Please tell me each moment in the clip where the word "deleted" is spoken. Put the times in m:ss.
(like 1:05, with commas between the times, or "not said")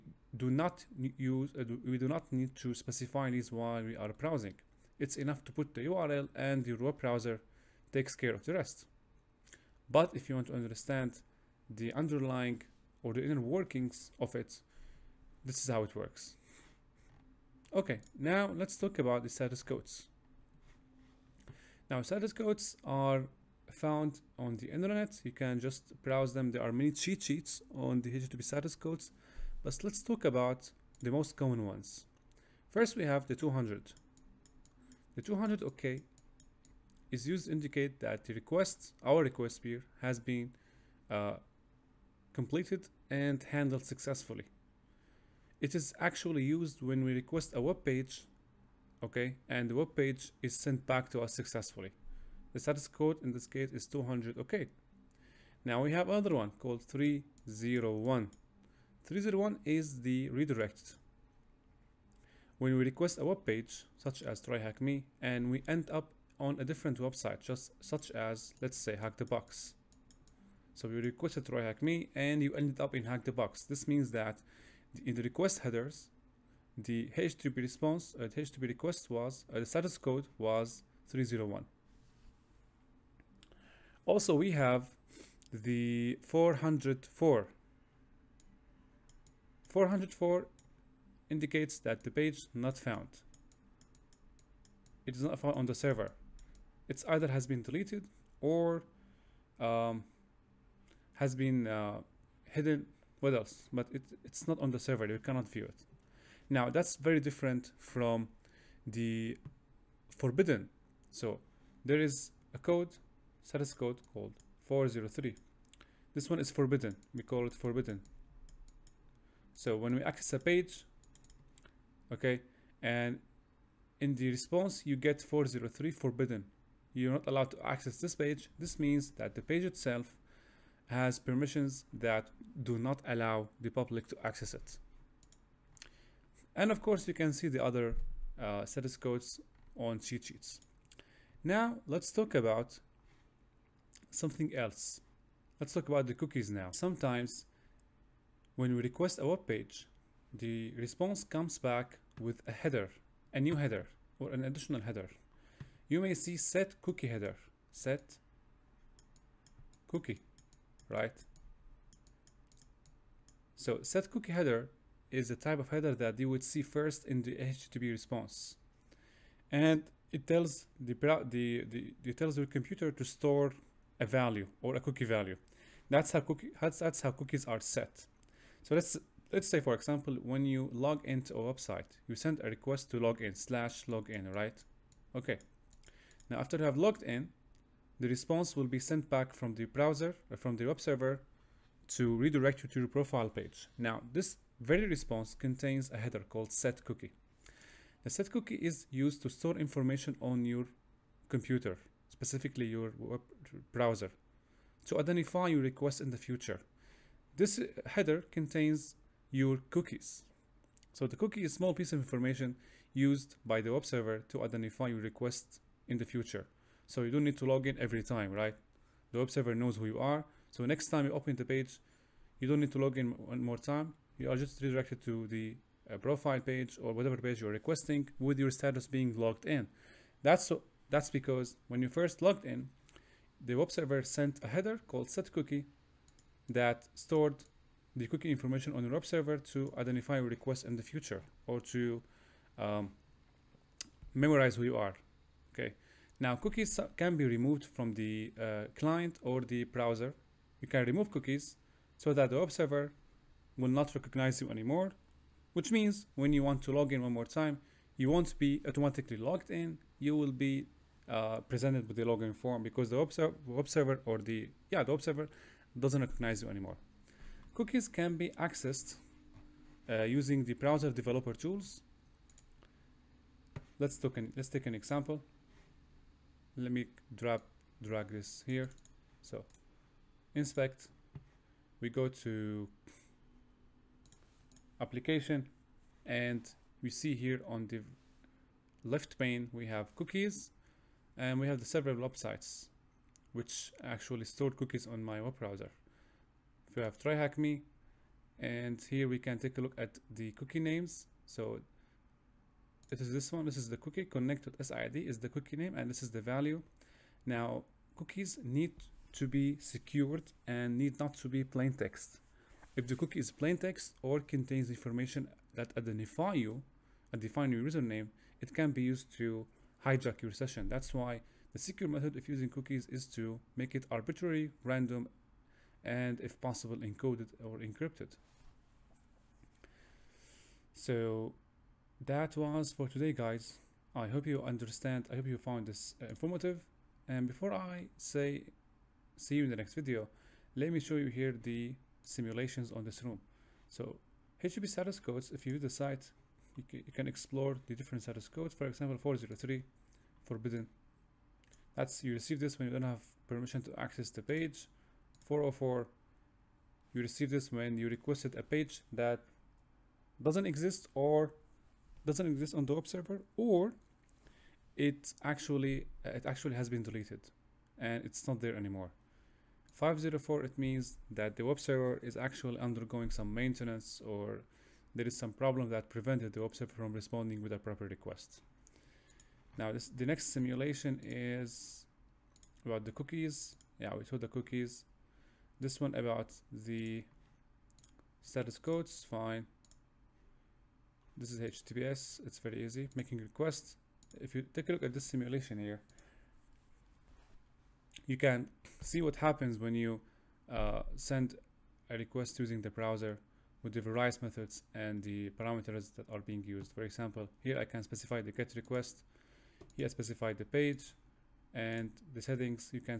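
1:37, 6:06.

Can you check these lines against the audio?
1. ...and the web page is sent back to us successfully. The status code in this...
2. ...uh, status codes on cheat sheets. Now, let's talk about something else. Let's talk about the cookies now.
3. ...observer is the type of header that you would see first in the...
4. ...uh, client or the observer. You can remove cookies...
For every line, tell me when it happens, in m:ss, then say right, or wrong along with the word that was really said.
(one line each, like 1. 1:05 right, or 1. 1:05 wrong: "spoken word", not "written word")
1. 0:49 right
2. 2:18 right
3. 2:44 wrong: "header", not "observer"
4. 4:08 wrong: "browser", not "observer".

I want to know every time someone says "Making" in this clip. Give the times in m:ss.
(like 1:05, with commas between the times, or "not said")
6:32.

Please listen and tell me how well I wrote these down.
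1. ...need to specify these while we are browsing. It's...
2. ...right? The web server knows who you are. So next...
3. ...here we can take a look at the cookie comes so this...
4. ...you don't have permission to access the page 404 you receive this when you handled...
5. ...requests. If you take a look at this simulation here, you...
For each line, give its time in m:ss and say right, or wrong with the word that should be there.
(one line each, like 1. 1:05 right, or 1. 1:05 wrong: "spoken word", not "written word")
1. 0:02 right
2. 3:38 right
3. 4:58 wrong: "names", not "comes"
4. 5:52 wrong: "requested", not "handled"
5. 6:33 right.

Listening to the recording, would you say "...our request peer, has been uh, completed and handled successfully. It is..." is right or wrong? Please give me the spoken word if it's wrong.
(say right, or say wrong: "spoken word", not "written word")
right.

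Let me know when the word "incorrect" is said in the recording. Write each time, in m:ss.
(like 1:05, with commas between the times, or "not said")
not said.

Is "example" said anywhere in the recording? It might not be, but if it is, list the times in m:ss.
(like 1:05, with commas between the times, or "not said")
2:59, 4:34, 5:48, 6:46.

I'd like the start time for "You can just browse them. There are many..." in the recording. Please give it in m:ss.
0:25.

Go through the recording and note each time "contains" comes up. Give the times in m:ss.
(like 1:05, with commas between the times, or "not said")
3:15, 3:28, 5:14.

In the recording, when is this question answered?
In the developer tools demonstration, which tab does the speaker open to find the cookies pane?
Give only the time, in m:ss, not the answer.
4:44.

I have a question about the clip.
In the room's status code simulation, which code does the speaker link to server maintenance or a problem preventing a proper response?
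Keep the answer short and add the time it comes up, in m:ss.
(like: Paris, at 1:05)
504, at 6:09.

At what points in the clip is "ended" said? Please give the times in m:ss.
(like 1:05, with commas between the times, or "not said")
1:12.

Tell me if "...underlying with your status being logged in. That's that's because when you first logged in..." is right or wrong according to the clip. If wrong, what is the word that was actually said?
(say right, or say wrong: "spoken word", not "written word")
wrong: "requesting", not "underlying".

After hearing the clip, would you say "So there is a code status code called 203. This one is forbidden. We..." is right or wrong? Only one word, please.
wrong.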